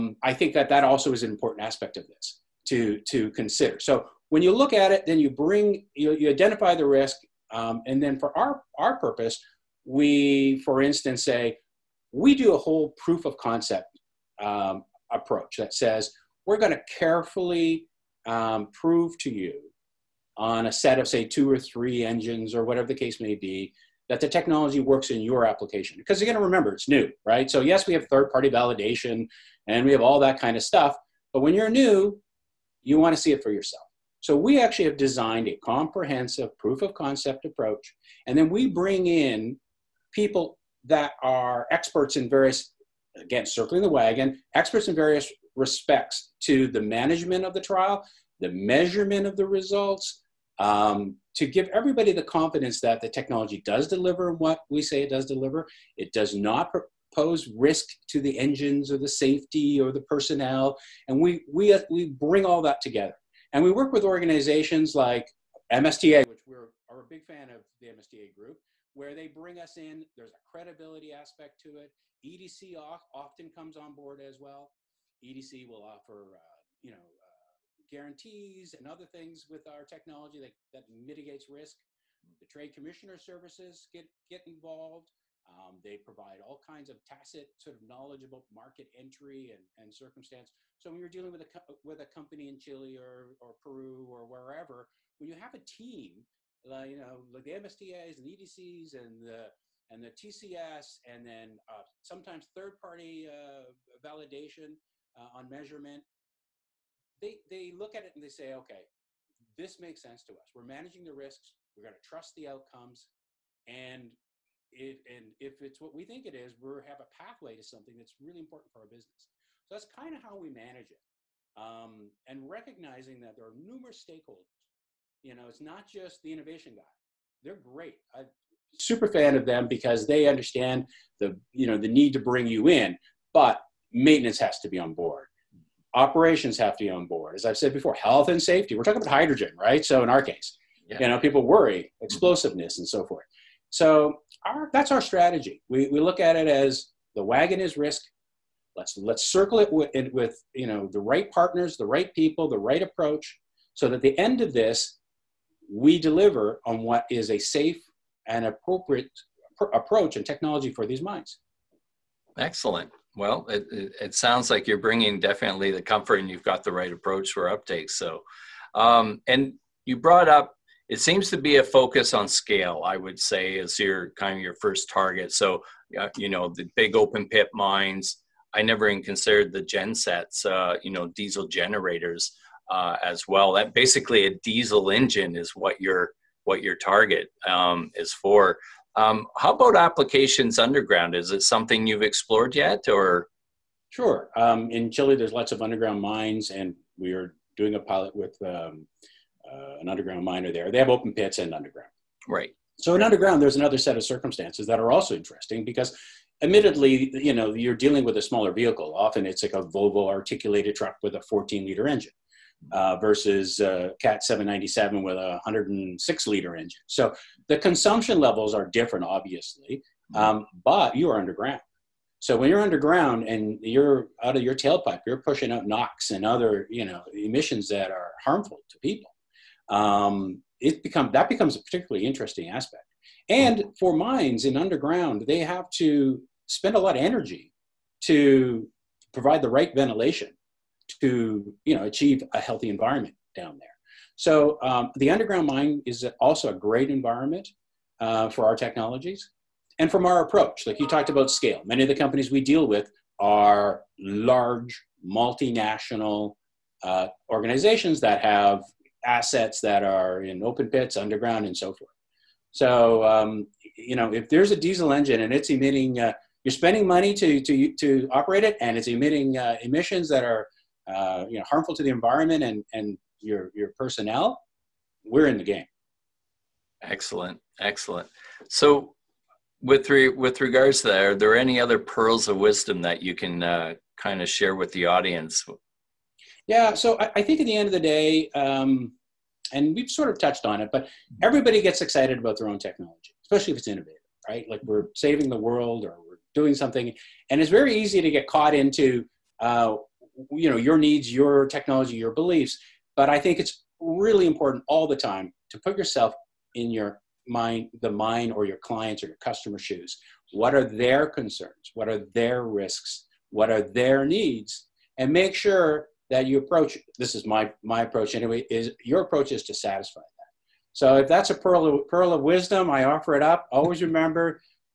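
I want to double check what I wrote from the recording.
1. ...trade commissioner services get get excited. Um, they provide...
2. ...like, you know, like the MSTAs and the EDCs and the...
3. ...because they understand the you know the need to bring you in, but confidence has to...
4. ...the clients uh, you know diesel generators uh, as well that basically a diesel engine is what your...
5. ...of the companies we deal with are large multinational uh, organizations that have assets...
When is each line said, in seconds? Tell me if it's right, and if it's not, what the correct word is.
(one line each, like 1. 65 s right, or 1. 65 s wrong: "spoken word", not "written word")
1. 82 s wrong: "involved", not "excited"
2. 96 s right
3. 129 s wrong: "maintenance", not "confidence"
4. 179 s wrong: "gensets", not "clients"
5. 251 s right.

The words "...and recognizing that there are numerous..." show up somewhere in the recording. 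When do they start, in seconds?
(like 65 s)
122 s.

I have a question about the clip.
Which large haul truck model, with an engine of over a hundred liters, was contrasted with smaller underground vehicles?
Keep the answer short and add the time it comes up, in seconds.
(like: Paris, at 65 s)
Cat 797, at 214 s.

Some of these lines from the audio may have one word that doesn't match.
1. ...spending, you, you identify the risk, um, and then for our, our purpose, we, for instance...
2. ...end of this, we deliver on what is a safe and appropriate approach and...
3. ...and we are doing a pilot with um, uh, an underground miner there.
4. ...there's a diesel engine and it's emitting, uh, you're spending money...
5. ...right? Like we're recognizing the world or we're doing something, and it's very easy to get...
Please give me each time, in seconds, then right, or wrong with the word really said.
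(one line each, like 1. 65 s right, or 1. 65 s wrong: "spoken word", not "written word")
1. 5 s wrong: "bring", not "spending"
2. 154 s right
3. 196 s right
4. 264 s right
5. 294 s wrong: "saving", not "recognizing".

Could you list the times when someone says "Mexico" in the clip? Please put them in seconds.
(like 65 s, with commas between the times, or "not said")
not said.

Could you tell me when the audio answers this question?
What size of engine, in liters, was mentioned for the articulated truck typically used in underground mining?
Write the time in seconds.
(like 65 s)
211 s.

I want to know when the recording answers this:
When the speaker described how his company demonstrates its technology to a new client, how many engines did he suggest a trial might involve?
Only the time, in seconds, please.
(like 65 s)
21 s.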